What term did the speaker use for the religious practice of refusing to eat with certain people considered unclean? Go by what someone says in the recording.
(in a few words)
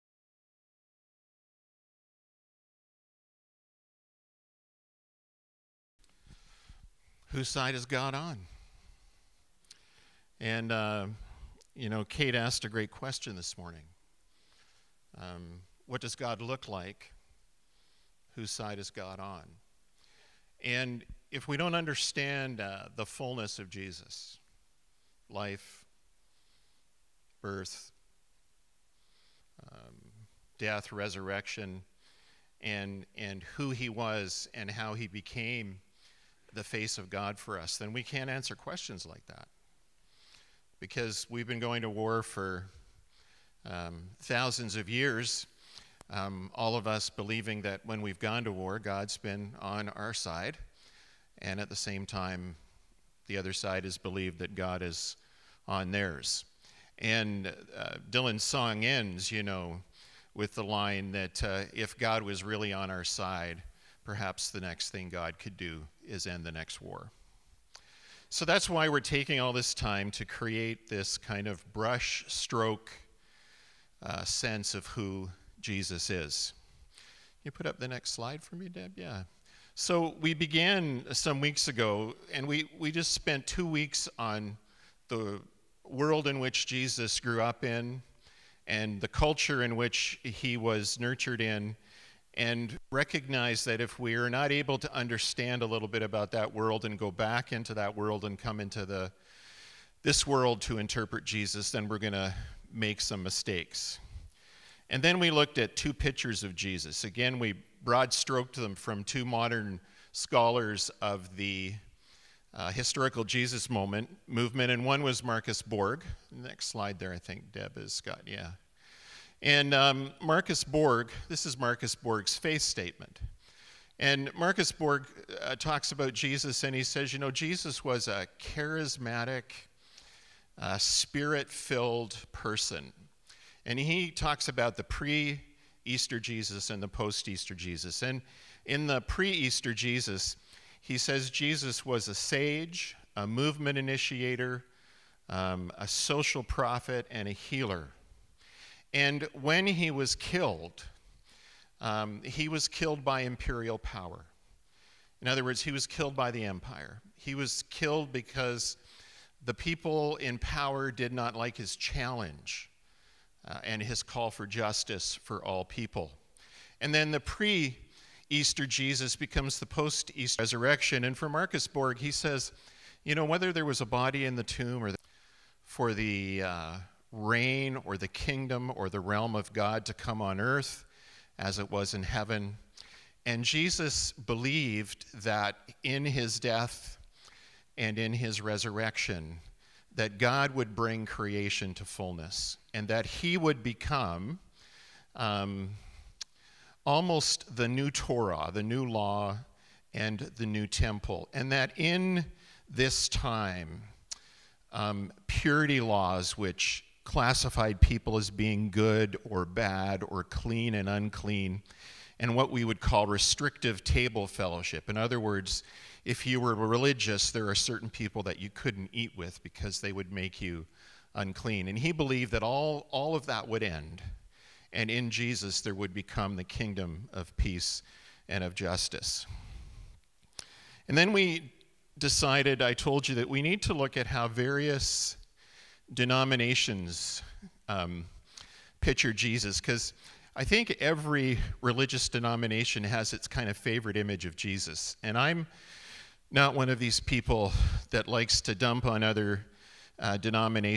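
Restrictive table fellowship.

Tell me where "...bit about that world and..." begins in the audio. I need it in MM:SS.
01:35.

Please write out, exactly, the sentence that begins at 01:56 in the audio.
Next slide there, I think Deb has got, yeah.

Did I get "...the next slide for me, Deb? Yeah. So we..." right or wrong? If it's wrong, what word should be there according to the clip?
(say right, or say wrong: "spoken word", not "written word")
right.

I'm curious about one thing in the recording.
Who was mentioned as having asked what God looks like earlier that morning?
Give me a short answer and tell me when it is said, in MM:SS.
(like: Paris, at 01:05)
Kate, at 00:12.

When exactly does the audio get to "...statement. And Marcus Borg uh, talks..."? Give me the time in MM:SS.
02:02.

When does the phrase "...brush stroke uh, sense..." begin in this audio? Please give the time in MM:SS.
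01:11.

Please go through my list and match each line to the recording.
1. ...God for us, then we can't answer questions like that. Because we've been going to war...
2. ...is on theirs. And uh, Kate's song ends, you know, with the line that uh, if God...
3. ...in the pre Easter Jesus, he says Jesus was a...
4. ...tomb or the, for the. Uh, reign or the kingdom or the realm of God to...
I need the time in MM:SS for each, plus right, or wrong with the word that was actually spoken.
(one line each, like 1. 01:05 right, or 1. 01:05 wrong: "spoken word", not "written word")
1. 00:37 right
2. 00:54 wrong: "Dylan", not "Kate"
3. 02:18 right
4. 02:54 right.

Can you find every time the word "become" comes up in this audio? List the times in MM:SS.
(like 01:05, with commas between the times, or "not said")
02:49, 03:13, 03:45.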